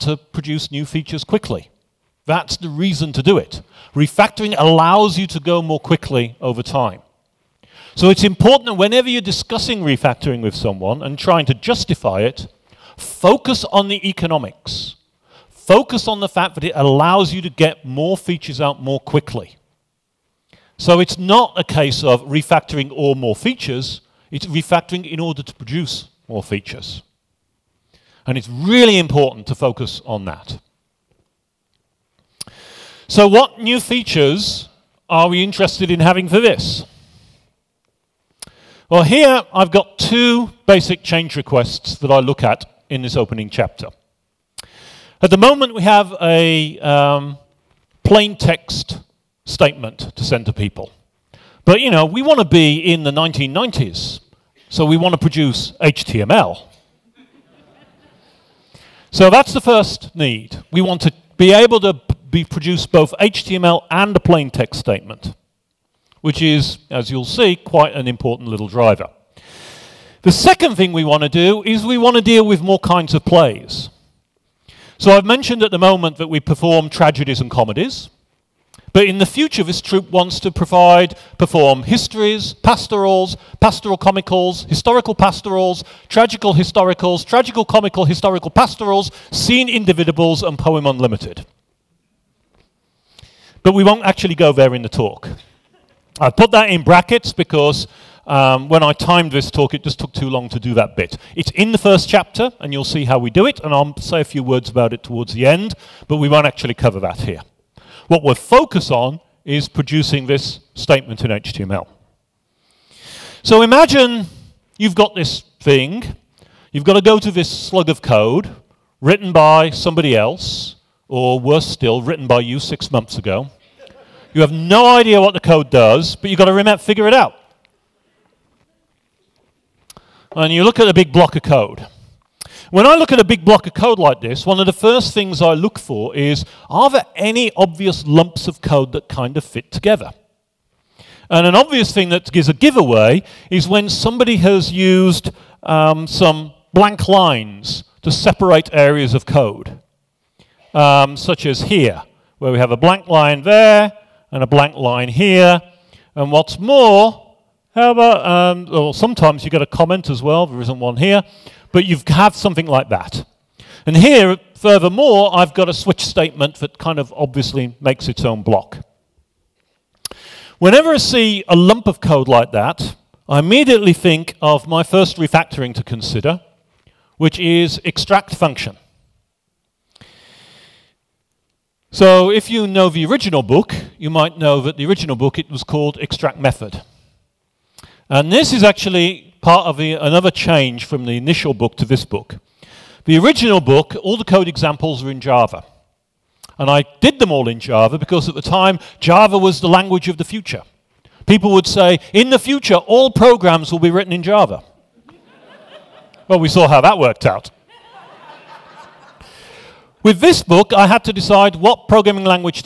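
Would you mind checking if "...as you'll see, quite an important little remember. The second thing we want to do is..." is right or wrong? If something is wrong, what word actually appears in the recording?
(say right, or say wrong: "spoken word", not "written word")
wrong: "driver", not "remember".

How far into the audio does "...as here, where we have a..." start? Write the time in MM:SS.
02:31.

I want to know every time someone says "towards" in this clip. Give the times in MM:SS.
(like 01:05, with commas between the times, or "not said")
01:45.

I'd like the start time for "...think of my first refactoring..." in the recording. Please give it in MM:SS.
02:53.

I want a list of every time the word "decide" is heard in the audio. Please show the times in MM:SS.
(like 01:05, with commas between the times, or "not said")
03:31.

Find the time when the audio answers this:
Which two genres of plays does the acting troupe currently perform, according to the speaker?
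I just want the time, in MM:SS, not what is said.
01:16.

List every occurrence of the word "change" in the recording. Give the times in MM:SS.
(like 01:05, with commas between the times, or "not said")
00:41, 03:10.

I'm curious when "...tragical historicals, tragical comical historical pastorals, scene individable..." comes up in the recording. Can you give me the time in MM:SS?
01:26.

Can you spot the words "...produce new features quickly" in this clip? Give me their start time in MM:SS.
00:00.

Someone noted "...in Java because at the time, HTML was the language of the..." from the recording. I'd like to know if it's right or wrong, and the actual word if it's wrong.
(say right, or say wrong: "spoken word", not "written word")
wrong: "Java", not "HTML".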